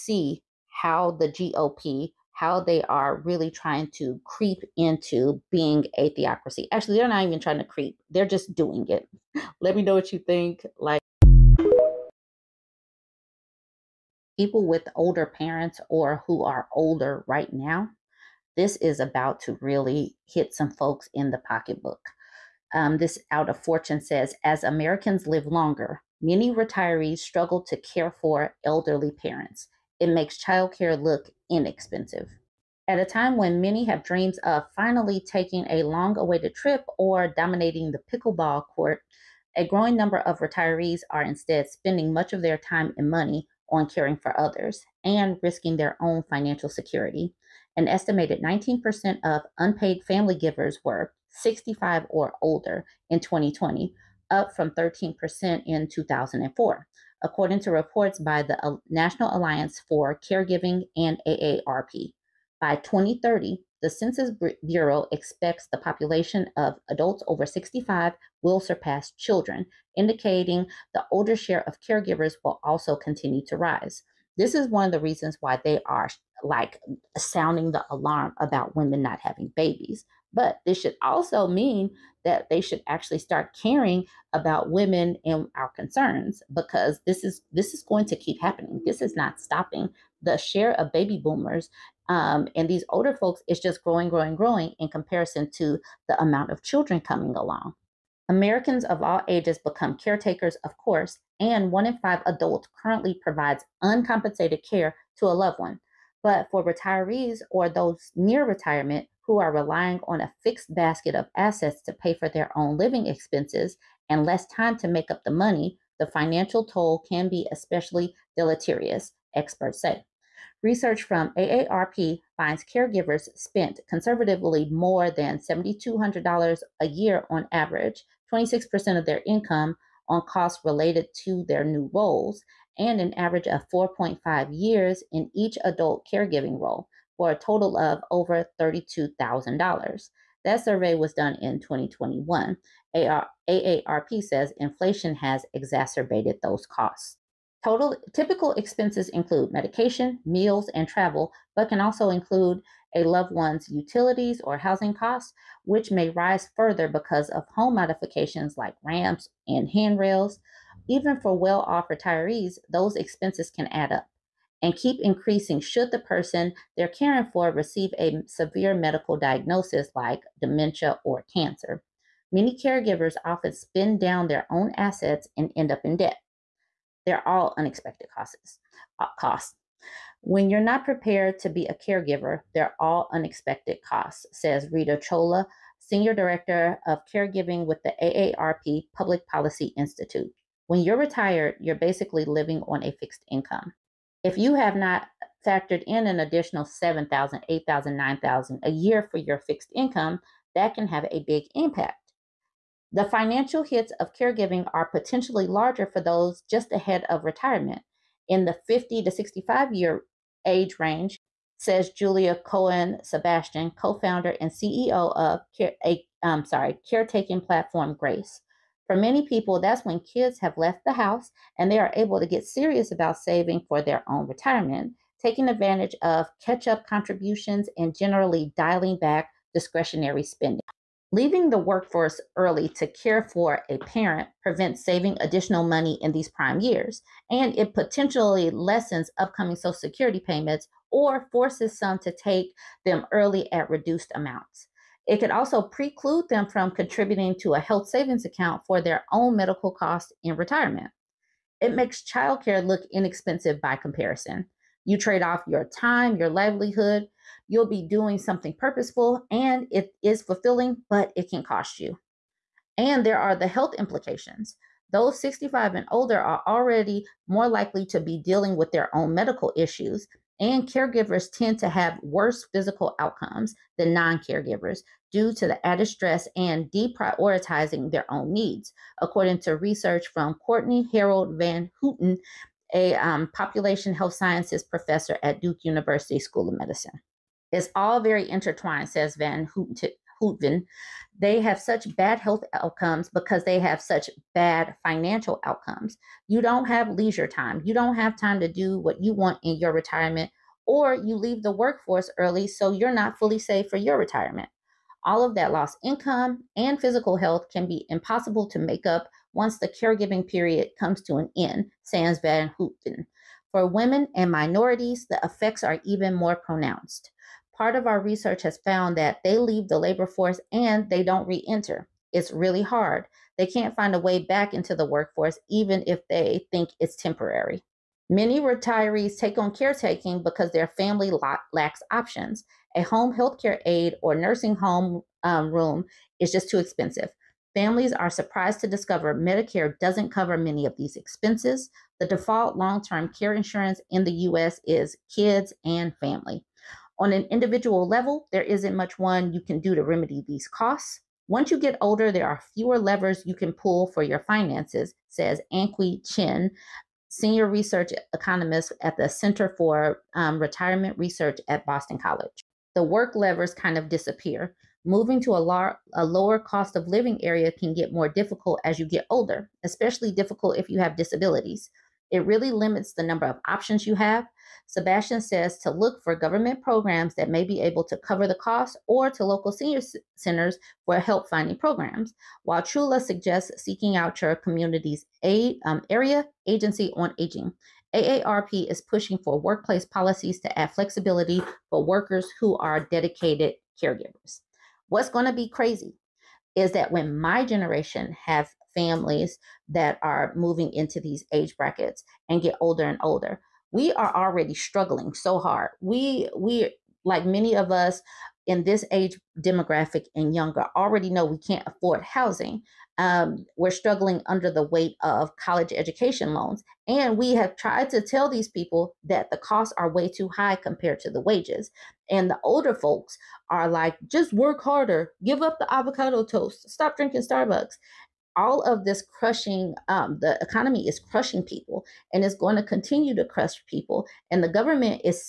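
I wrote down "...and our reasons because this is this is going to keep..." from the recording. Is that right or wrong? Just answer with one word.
wrong.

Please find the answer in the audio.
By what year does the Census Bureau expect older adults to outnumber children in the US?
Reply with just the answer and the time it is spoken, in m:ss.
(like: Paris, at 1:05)
2030, at 1:02.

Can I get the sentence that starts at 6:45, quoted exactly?
We we like many of us in this age demographic and younger already know we can't afford housing.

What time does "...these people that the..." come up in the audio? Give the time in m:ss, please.
6:58.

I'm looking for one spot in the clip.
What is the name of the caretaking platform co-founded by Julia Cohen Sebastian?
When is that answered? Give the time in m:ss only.
3:37.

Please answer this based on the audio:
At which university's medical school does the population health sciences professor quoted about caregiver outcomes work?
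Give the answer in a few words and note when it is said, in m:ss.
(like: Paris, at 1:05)
Duke University, at 4:45.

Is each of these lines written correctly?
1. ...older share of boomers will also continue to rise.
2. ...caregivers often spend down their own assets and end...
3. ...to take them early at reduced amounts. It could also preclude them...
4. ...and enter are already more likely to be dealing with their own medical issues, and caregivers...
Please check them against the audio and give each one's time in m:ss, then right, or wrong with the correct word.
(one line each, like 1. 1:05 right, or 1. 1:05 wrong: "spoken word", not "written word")
1. 1:11 wrong: "caregivers", not "boomers"
2. 2:52 right
3. 4:01 right
4. 4:25 wrong: "older", not "enter".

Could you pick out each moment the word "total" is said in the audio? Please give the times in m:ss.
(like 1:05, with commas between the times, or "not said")
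2:17, 2:27.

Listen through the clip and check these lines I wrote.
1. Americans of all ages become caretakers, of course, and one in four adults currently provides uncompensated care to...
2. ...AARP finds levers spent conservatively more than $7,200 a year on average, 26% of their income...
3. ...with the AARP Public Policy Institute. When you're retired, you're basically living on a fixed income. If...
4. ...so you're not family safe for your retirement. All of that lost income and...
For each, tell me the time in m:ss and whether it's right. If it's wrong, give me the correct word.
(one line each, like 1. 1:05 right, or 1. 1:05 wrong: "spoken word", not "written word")
1. 1:38 wrong: "five", not "four"
2. 2:01 wrong: "caregivers", not "levers"
3. 3:07 right
4. 5:02 wrong: "fully", not "family".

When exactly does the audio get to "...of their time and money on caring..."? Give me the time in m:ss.
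0:42.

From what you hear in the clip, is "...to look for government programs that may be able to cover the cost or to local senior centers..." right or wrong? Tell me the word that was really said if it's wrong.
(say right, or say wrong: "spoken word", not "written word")
right.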